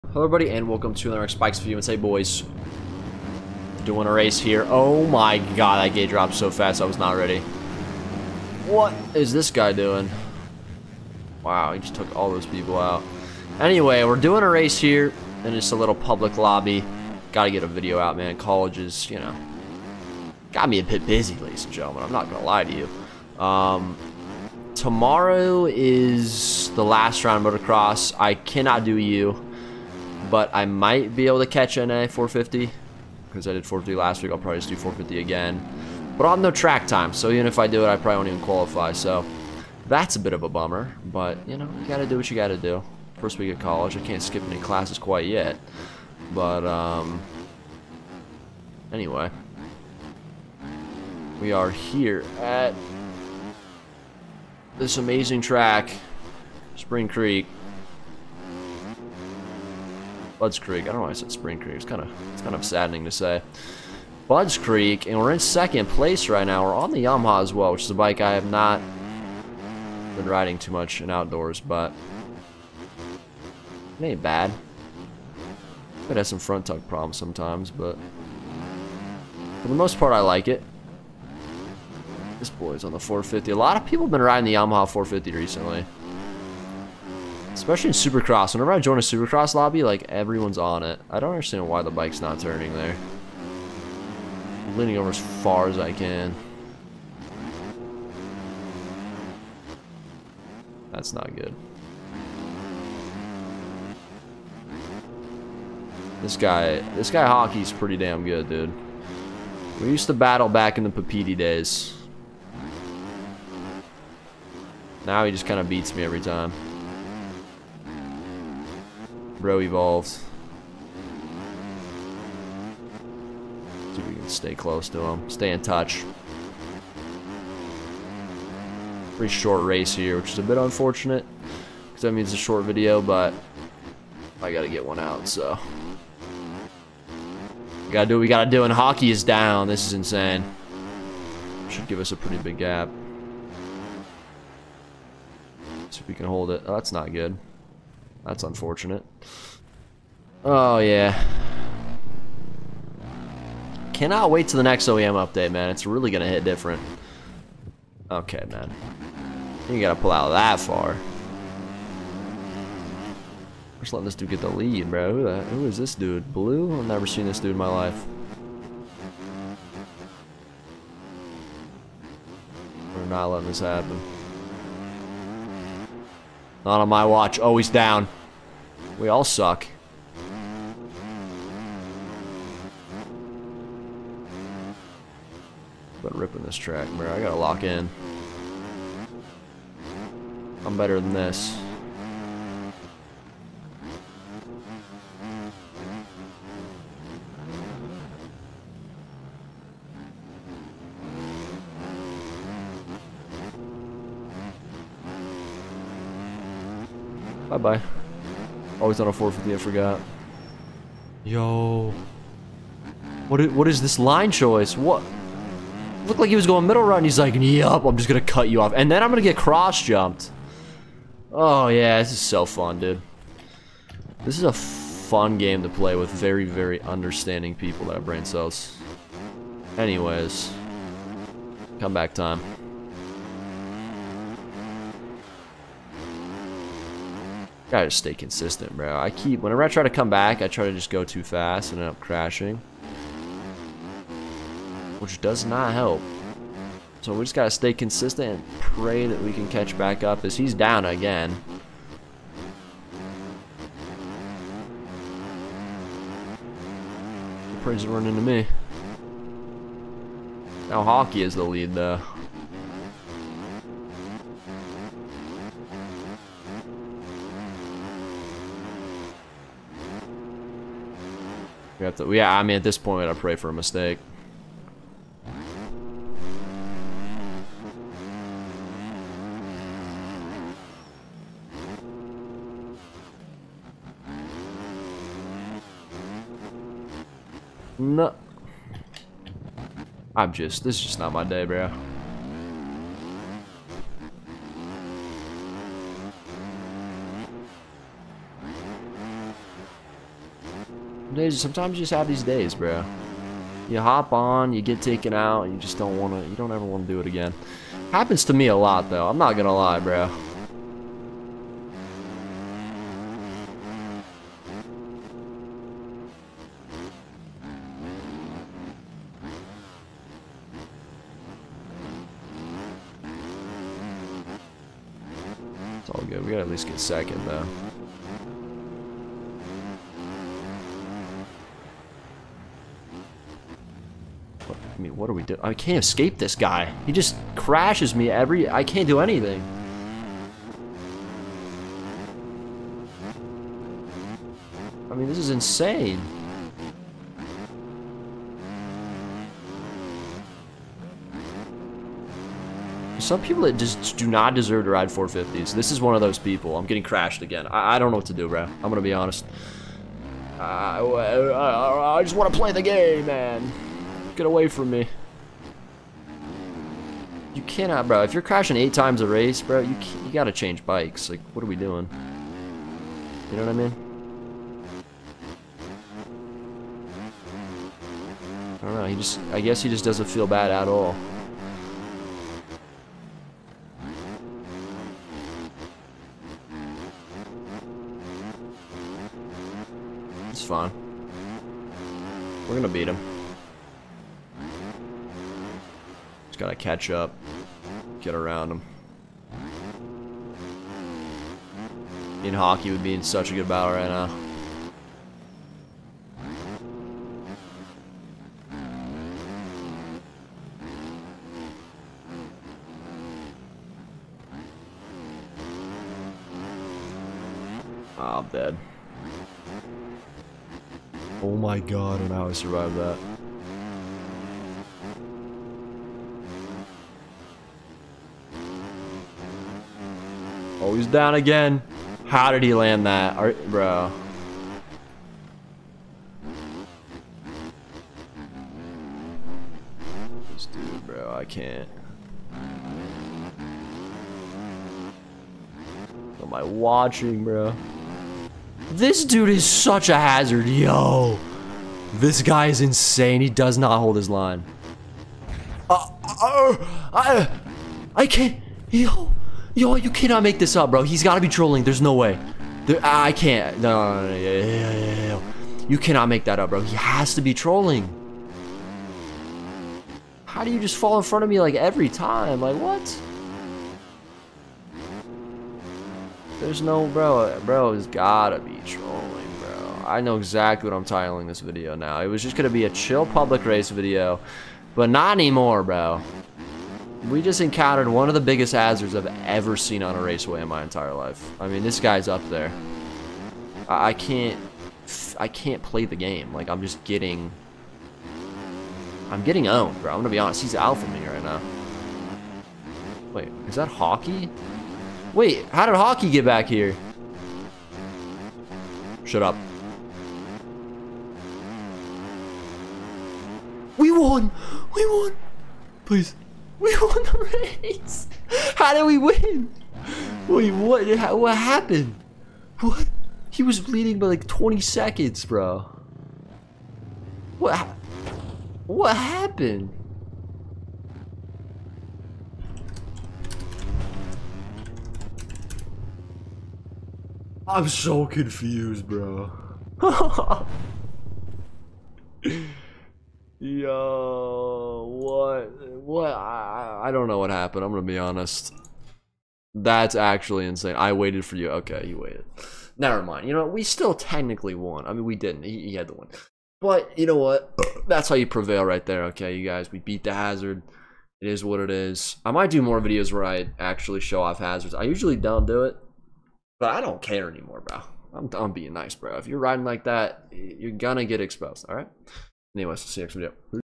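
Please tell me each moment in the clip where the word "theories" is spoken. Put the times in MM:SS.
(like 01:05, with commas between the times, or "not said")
not said.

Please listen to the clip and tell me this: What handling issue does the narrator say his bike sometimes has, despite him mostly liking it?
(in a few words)
Front tuck problems.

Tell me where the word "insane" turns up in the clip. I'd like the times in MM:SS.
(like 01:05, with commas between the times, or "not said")
02:19, 05:45, 07:32, 09:10.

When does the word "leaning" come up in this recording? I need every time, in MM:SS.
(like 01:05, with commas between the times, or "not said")
01:34.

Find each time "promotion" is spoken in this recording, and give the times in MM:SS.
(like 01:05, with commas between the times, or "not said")
not said.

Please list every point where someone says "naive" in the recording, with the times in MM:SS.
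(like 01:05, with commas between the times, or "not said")
not said.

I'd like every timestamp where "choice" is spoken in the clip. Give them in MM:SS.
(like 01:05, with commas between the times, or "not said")
03:34.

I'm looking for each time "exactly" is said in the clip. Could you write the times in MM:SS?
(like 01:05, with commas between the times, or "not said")
08:00.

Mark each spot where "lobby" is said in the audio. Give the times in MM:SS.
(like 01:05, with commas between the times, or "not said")
00:16, 01:29.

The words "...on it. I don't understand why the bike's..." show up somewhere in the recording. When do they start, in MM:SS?
01:30.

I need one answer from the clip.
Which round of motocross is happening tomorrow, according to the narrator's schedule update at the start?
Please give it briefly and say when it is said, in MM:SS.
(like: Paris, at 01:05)
The last round, at 00:26.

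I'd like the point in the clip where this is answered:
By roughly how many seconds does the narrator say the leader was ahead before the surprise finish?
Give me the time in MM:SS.
08:44.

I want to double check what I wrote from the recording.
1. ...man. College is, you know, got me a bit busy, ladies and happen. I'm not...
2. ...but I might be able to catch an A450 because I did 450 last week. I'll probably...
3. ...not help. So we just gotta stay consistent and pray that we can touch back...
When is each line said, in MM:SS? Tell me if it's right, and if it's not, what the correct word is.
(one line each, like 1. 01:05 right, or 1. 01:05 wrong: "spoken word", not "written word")
1. 00:18 wrong: "gentlemen", not "happen"
2. 00:30 right
3. 04:05 wrong: "catch", not "touch".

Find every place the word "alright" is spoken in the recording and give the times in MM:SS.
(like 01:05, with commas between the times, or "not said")
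not said.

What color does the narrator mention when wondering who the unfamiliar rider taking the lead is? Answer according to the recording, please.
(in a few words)
Blue.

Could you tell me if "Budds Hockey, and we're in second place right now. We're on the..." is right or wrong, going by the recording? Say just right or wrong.
wrong.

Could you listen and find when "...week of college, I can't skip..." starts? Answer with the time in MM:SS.
00:43.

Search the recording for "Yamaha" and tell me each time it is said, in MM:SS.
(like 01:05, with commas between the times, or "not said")
01:07, 01:24.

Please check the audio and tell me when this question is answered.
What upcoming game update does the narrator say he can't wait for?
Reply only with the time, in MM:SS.
02:34.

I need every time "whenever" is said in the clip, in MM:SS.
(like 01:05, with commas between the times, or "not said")
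01:28, 03:59.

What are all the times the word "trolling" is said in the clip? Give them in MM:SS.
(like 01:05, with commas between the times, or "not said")
07:41, 07:47, 07:58.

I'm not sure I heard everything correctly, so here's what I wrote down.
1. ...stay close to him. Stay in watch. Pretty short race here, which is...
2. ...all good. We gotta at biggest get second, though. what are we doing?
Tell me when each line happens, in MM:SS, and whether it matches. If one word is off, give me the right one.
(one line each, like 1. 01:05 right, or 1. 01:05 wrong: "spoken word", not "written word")
1. 02:04 wrong: "touch", not "watch"
2. 05:25 wrong: "least", not "biggest".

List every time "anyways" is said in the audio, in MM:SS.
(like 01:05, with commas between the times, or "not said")
00:13, 00:48, 03:49, 09:32.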